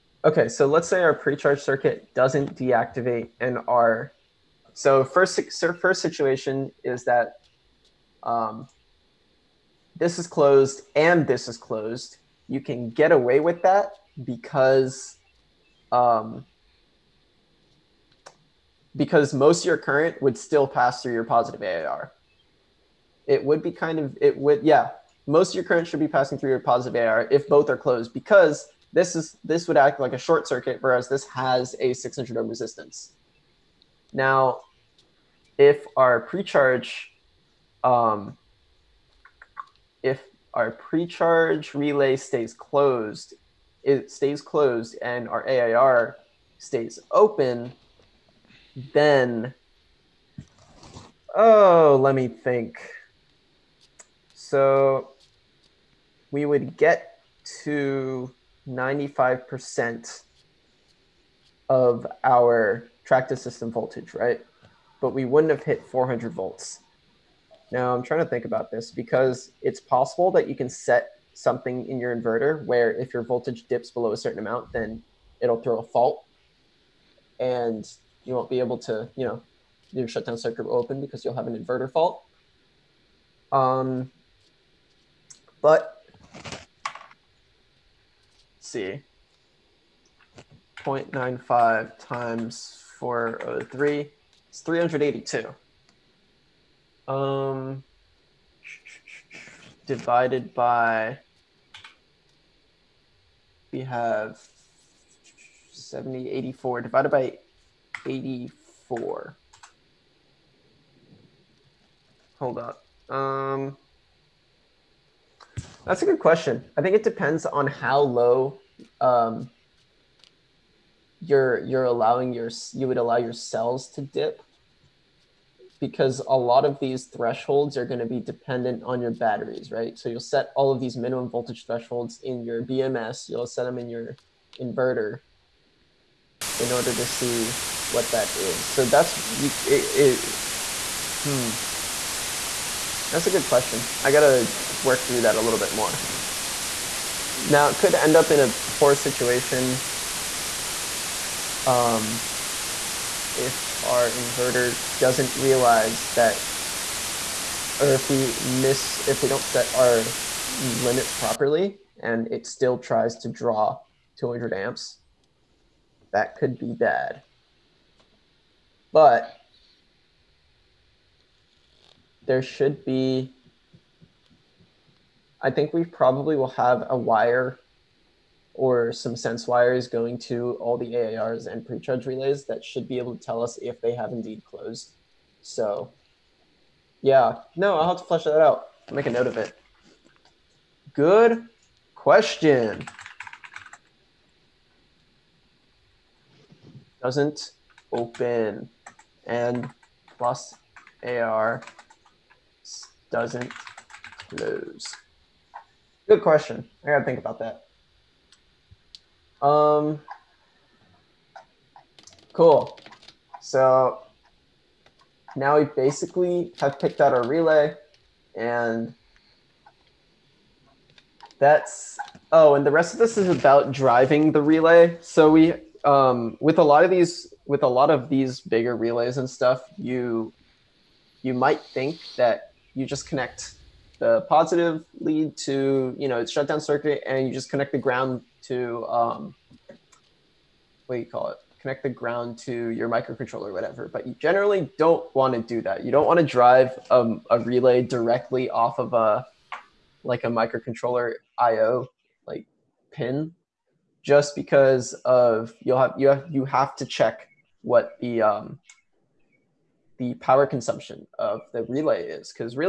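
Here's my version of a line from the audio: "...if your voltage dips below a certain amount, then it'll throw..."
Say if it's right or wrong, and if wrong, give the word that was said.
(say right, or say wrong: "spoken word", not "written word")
right.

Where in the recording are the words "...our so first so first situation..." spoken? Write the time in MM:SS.
00:03.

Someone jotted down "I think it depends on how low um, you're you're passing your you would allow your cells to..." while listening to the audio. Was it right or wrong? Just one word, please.
wrong.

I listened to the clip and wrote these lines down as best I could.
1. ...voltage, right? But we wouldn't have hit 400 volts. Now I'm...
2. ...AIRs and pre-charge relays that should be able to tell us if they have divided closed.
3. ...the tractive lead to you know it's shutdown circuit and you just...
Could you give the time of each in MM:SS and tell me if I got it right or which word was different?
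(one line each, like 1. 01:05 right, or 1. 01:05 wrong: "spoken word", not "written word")
1. 01:03 right
2. 03:00 wrong: "indeed", not "divided"
3. 03:54 wrong: "positive", not "tractive".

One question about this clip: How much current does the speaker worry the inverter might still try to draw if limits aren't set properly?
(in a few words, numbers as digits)
200 amps.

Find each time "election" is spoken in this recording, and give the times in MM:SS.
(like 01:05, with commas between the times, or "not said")
not said.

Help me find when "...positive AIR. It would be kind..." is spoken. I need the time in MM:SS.
00:21.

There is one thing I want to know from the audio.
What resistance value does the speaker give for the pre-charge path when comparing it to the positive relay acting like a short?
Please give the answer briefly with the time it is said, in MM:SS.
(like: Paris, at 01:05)
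600 ohms, at 00:31.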